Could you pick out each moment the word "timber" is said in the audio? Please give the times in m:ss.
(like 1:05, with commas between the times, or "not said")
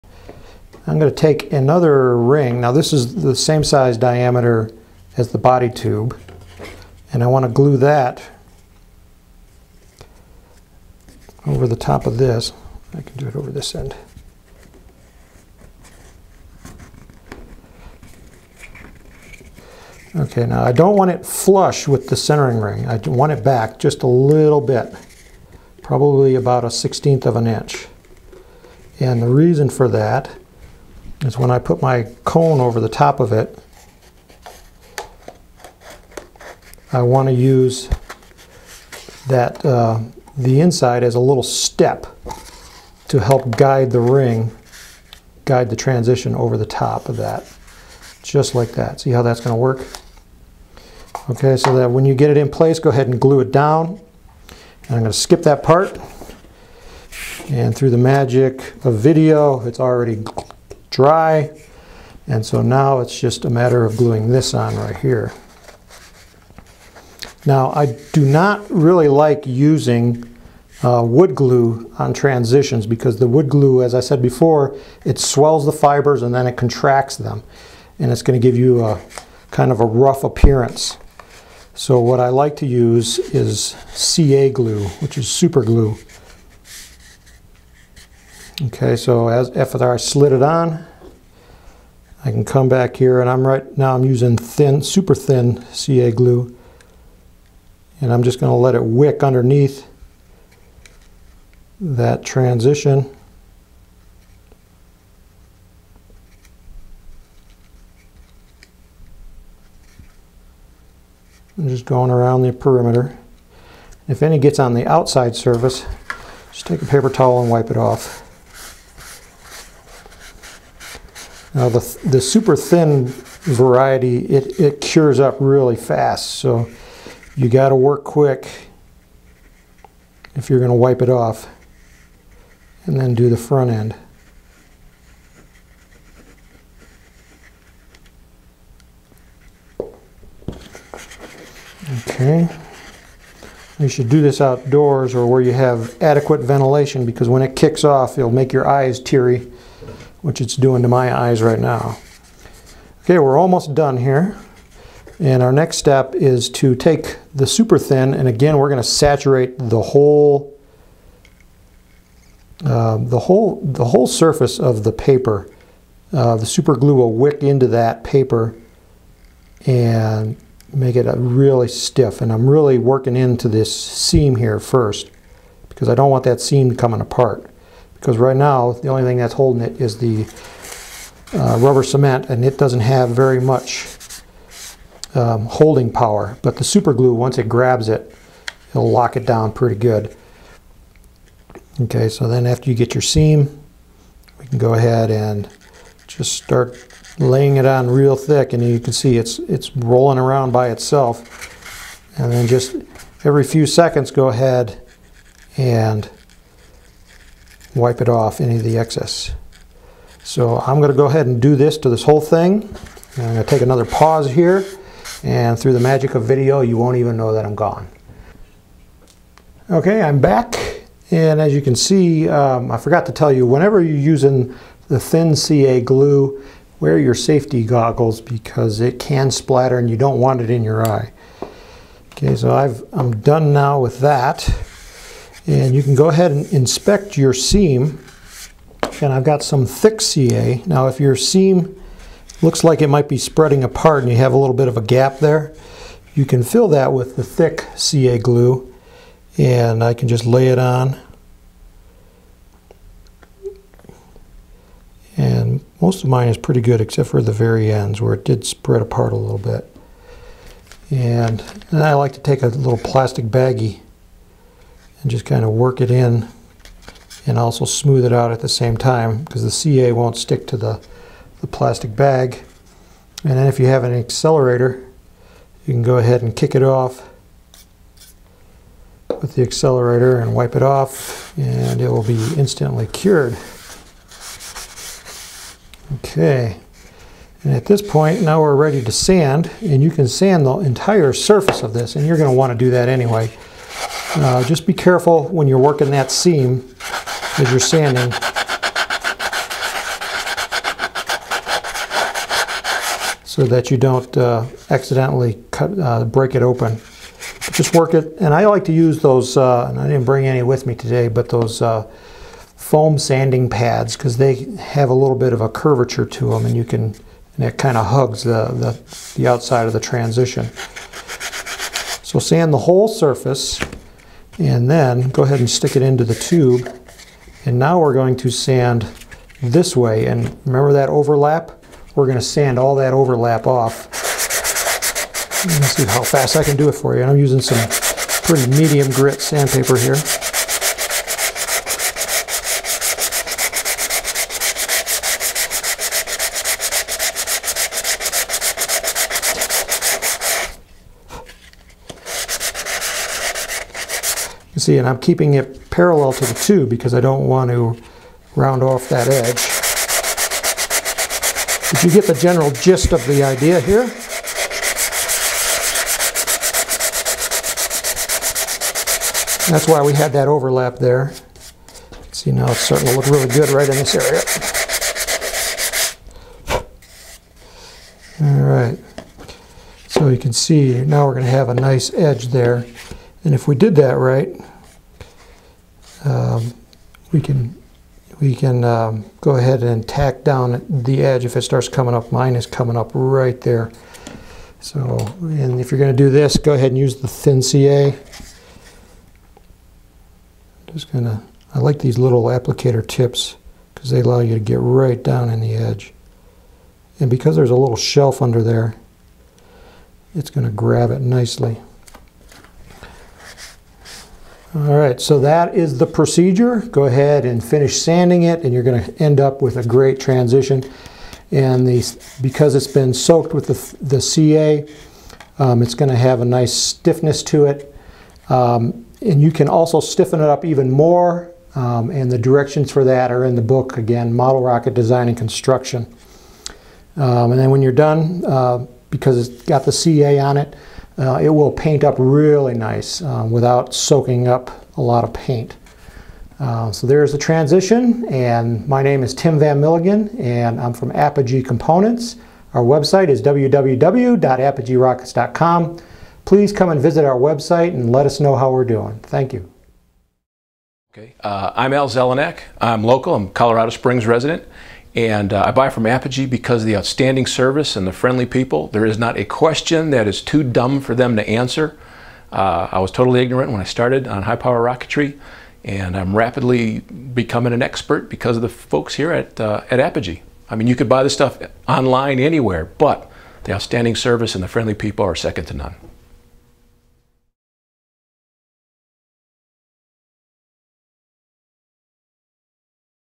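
not said.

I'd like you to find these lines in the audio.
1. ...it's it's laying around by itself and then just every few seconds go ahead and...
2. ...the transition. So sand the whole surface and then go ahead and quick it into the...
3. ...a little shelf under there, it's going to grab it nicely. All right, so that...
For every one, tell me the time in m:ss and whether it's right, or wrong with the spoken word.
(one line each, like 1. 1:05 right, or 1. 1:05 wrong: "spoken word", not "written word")
1. 3:19 wrong: "rolling", not "laying"
2. 5:19 wrong: "stick", not "quick"
3. 6:47 right.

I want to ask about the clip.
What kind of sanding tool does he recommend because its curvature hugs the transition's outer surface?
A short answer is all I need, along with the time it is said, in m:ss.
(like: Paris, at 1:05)
foam sanding pads, at 5:12.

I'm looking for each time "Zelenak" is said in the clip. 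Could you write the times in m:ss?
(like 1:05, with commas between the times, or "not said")
7:41.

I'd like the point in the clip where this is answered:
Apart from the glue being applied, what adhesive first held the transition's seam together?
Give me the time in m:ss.
3:01.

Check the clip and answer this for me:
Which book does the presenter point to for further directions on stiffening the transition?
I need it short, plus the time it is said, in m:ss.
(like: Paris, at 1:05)
Model Rocket Design and Construction, at 7:14.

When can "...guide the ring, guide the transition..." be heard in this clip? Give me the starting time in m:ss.
0:43.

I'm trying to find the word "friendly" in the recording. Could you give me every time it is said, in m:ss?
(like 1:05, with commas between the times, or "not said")
7:47, 8:04.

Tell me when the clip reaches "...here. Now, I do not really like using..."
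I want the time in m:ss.
1:04.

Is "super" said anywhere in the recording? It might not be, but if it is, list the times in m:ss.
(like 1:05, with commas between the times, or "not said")
1:25, 1:34, 2:02, 2:37, 2:46, 3:06.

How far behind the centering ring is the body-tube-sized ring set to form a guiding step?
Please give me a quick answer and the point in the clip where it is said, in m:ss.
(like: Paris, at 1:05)
1/16 of an inch, at 0:26.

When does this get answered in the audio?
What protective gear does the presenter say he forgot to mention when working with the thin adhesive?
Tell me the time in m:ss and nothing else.
3:47.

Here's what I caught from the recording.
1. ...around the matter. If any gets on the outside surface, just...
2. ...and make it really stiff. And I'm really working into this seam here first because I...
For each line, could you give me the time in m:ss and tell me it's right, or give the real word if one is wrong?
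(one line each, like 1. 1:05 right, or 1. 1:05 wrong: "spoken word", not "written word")
1. 1:52 wrong: "perimeter", not "matter"
2. 2:49 right.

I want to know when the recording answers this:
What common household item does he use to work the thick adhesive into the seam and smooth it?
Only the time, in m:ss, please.
4:22.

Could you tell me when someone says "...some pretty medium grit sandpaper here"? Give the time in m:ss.
5:37.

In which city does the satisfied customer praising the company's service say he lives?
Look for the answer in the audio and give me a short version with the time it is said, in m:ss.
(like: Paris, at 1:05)
Colorado Springs, at 7:43.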